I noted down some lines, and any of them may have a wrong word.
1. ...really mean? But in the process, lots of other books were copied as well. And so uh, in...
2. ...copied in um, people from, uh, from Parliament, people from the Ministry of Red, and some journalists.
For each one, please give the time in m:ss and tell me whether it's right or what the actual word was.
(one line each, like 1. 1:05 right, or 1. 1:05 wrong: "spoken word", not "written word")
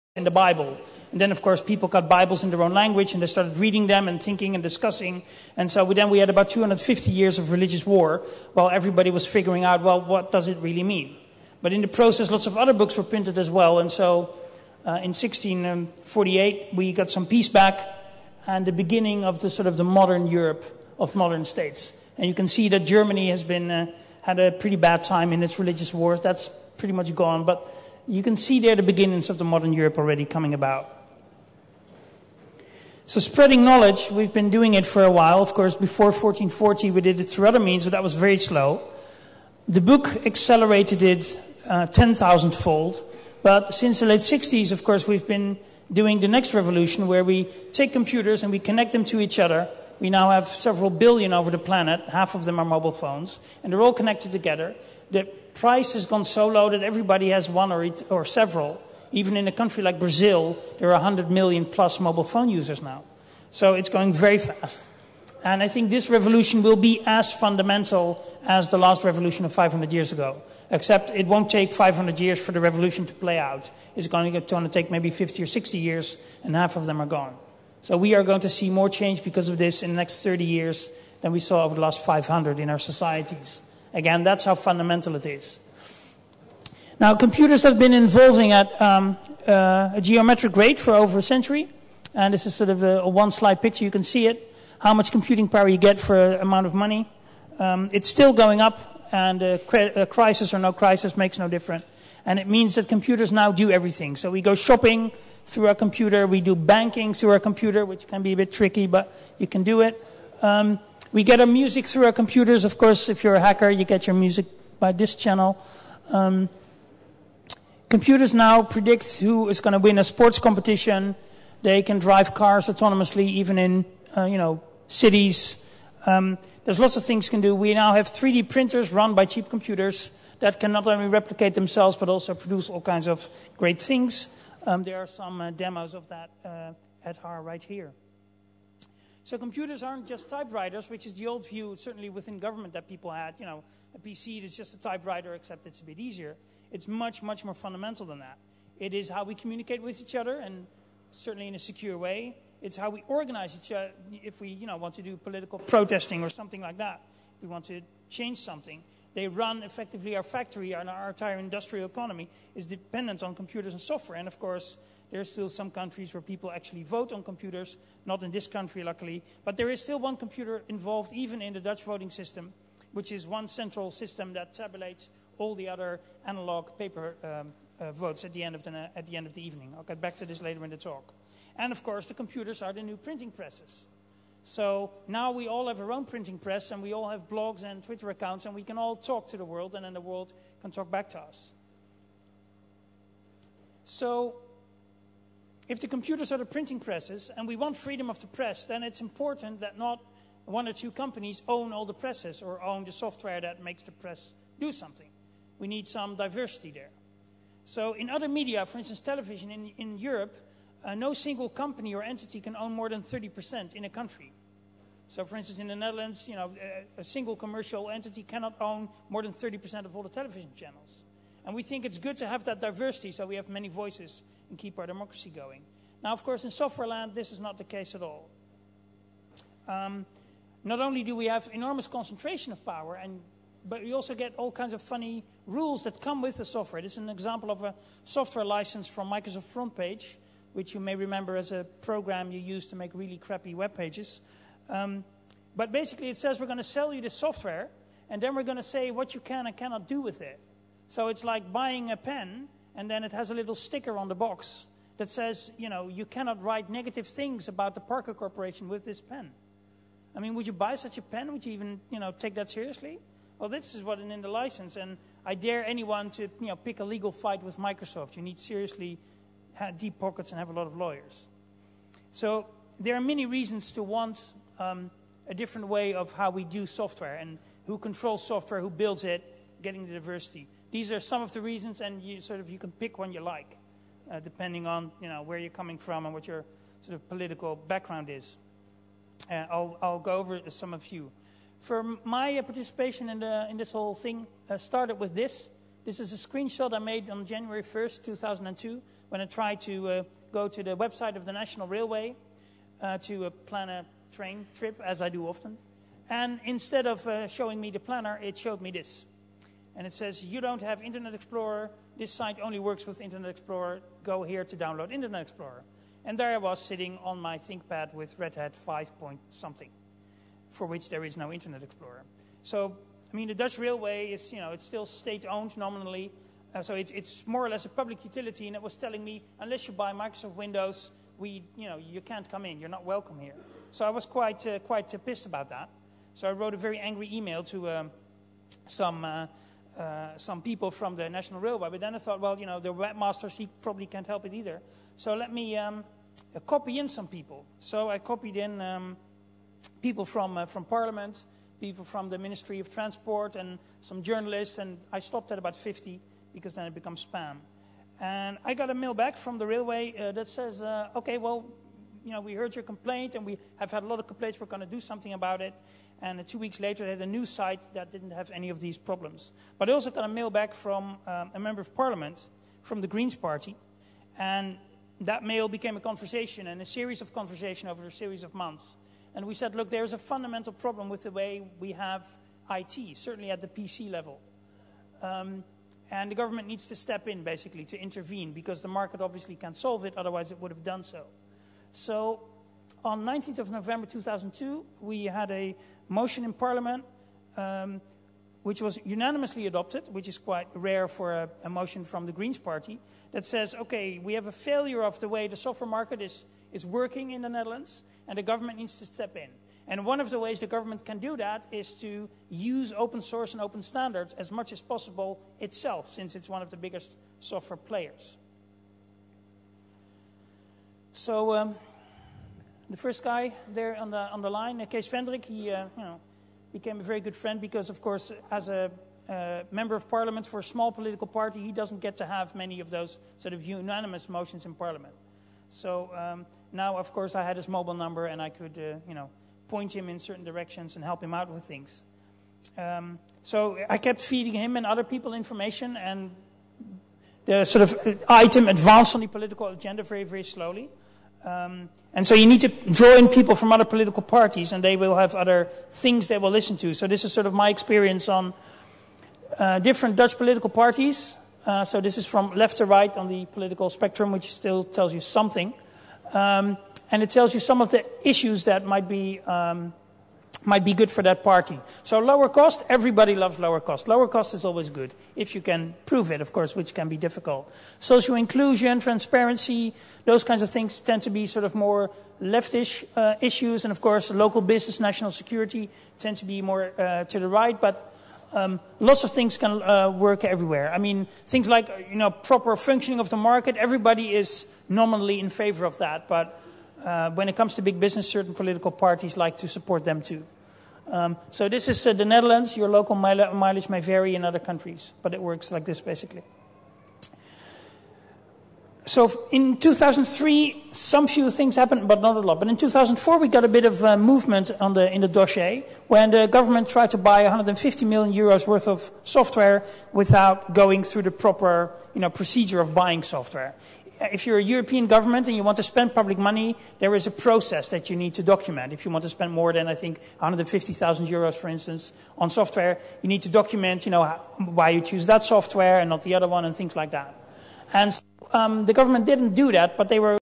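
1. 0:10 wrong: "printed", not "copied"
2. 5:47 wrong: "Transport", not "Red".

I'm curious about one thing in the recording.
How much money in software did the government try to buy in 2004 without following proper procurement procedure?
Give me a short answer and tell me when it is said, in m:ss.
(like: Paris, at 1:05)
150 million euros, at 8:37.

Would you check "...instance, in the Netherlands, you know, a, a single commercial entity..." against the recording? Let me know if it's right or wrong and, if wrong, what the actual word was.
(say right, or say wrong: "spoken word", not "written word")
right.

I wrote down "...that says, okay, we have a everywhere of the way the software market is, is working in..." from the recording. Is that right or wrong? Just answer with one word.
wrong.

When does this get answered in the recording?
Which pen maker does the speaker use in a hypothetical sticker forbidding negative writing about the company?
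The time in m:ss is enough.
4:17.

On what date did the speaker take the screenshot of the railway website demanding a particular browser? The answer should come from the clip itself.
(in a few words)
January 1, 2002.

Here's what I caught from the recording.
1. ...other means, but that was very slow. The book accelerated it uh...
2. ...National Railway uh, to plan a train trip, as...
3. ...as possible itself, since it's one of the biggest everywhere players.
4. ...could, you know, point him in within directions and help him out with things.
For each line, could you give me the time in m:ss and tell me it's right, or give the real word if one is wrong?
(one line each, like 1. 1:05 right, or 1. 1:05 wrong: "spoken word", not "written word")
1. 0:37 right
2. 5:01 right
3. 6:54 wrong: "software", not "everywhere"
4. 7:18 wrong: "certain", not "within".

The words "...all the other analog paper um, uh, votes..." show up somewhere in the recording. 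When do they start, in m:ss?
2:55.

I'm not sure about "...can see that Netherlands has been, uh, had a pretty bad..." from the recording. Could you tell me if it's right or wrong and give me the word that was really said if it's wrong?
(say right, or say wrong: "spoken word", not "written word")
wrong: "Germany", not "Netherlands".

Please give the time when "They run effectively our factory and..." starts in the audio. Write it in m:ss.
2:39.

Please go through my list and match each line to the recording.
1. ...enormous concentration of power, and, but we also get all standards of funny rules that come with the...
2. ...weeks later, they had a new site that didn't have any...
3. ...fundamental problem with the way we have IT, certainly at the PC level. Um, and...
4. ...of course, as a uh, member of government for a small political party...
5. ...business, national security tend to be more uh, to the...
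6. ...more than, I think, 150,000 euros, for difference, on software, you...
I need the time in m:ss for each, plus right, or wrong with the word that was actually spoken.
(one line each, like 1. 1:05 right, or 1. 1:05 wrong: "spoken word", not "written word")
1. 3:51 wrong: "kinds", not "standards"
2. 6:06 right
3. 6:19 right
4. 7:07 wrong: "parliament", not "government"
5. 8:04 right
6. 8:49 wrong: "instance", not "difference".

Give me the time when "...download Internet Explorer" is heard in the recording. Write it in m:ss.
5:14.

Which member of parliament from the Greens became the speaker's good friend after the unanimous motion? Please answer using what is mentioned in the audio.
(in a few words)
Kees Vendrik.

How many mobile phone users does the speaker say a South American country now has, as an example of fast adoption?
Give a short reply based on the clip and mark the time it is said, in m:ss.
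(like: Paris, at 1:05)
100 million plus, at 1:00.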